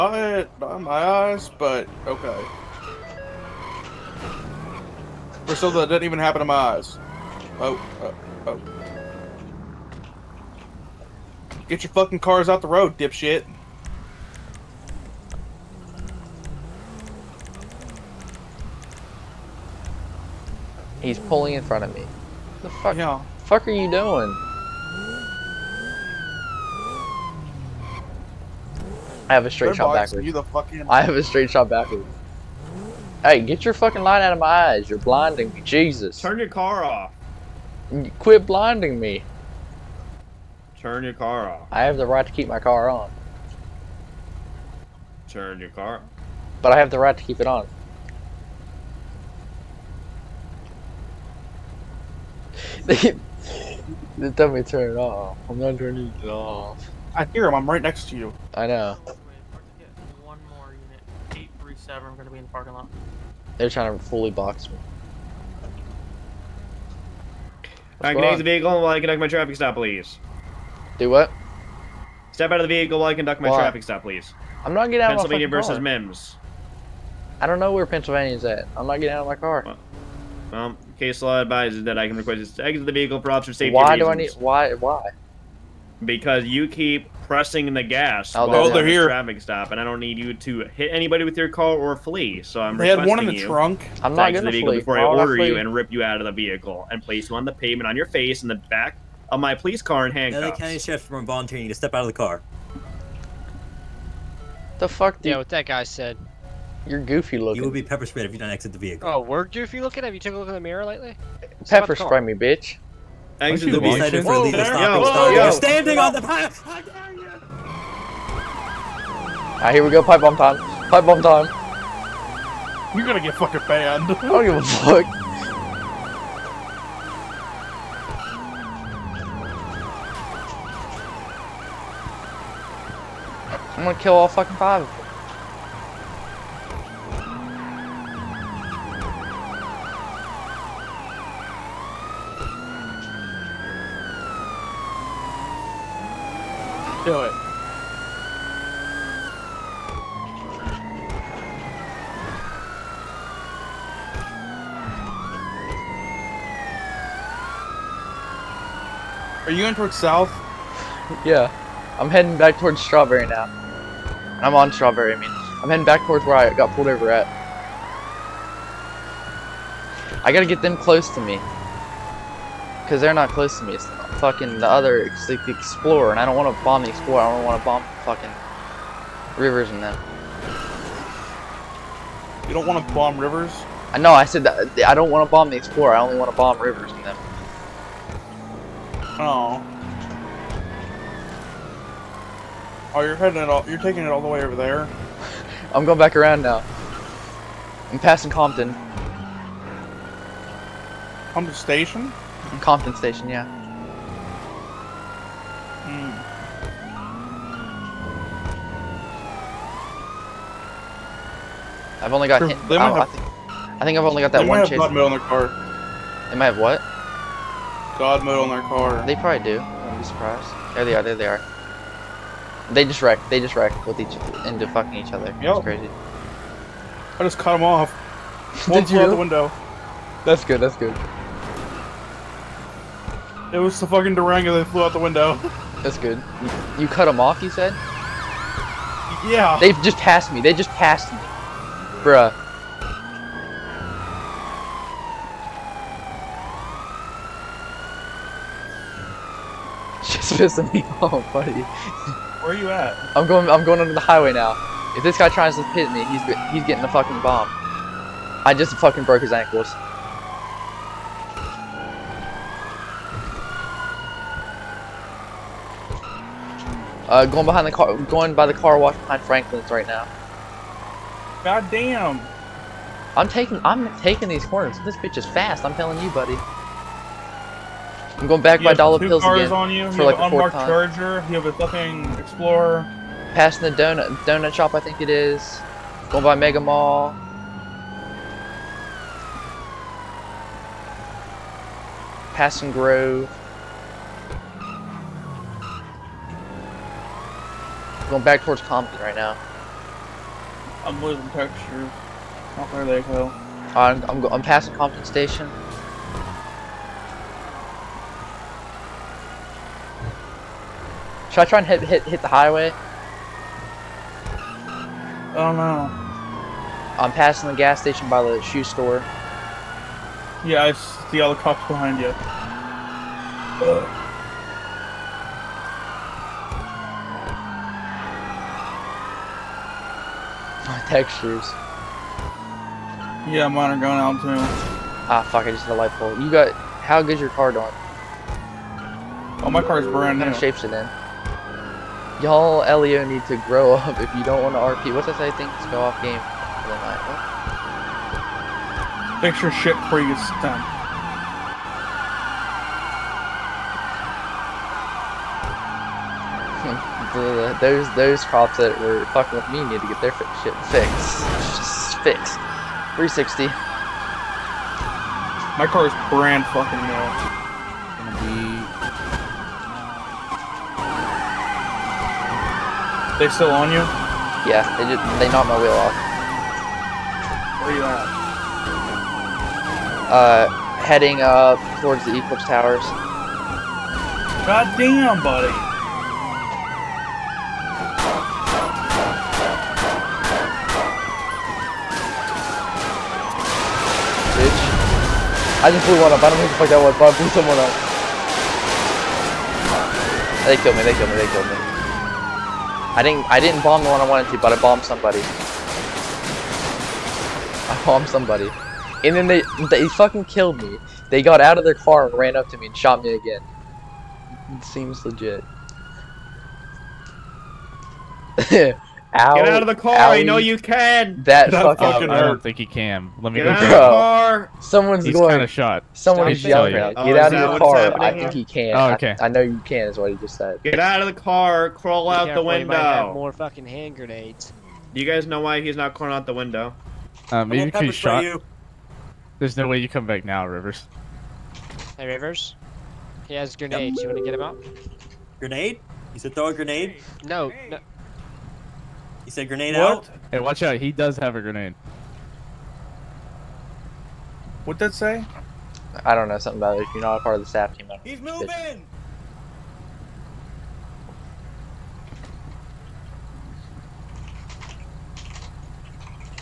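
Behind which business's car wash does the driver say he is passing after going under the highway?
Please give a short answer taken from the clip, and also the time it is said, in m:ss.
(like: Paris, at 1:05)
Franklin's, at 4:29.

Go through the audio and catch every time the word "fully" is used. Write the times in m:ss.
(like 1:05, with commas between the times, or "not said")
1:04.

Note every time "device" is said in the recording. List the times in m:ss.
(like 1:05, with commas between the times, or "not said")
not said.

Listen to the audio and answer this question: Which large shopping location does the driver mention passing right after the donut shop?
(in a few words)
Mega Mall.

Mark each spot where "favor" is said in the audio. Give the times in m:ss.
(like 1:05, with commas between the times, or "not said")
not said.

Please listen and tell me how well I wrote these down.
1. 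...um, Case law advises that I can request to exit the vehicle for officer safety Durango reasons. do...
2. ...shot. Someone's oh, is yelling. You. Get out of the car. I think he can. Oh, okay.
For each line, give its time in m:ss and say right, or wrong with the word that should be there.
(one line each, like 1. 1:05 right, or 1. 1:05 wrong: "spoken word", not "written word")
1. 1:20 wrong: "Why", not "Durango"
2. 7:05 right.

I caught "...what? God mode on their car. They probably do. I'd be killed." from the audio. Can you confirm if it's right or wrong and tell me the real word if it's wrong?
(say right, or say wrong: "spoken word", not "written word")
wrong: "surprised", not "killed".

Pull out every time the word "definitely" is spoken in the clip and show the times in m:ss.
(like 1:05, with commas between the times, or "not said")
0:54.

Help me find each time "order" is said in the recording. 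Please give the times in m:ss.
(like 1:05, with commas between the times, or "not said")
1:35.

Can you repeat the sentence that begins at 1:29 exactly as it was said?
traffic stop, and I don't need you to hit anybody with your car or flee.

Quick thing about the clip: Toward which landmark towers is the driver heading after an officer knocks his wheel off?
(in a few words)
Eclipse Towers.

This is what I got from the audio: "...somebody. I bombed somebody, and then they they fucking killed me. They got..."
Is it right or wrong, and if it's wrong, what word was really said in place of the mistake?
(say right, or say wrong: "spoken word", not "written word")
right.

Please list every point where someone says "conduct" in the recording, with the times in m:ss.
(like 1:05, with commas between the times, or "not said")
1:09, 1:13.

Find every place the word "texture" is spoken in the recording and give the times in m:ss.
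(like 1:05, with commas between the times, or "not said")
5:01, 5:30.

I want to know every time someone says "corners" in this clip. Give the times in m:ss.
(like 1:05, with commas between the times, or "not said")
4:34.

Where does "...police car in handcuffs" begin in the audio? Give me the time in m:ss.
1:39.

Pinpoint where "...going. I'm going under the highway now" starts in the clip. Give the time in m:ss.
4:13.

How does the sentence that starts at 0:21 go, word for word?
He's pulling in front of me.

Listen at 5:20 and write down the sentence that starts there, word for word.
Yeah, I see all the cops behind you.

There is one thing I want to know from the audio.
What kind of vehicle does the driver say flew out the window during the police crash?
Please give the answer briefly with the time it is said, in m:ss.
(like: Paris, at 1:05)
Durango, at 3:54.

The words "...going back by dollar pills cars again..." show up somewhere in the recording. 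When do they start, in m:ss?
4:38.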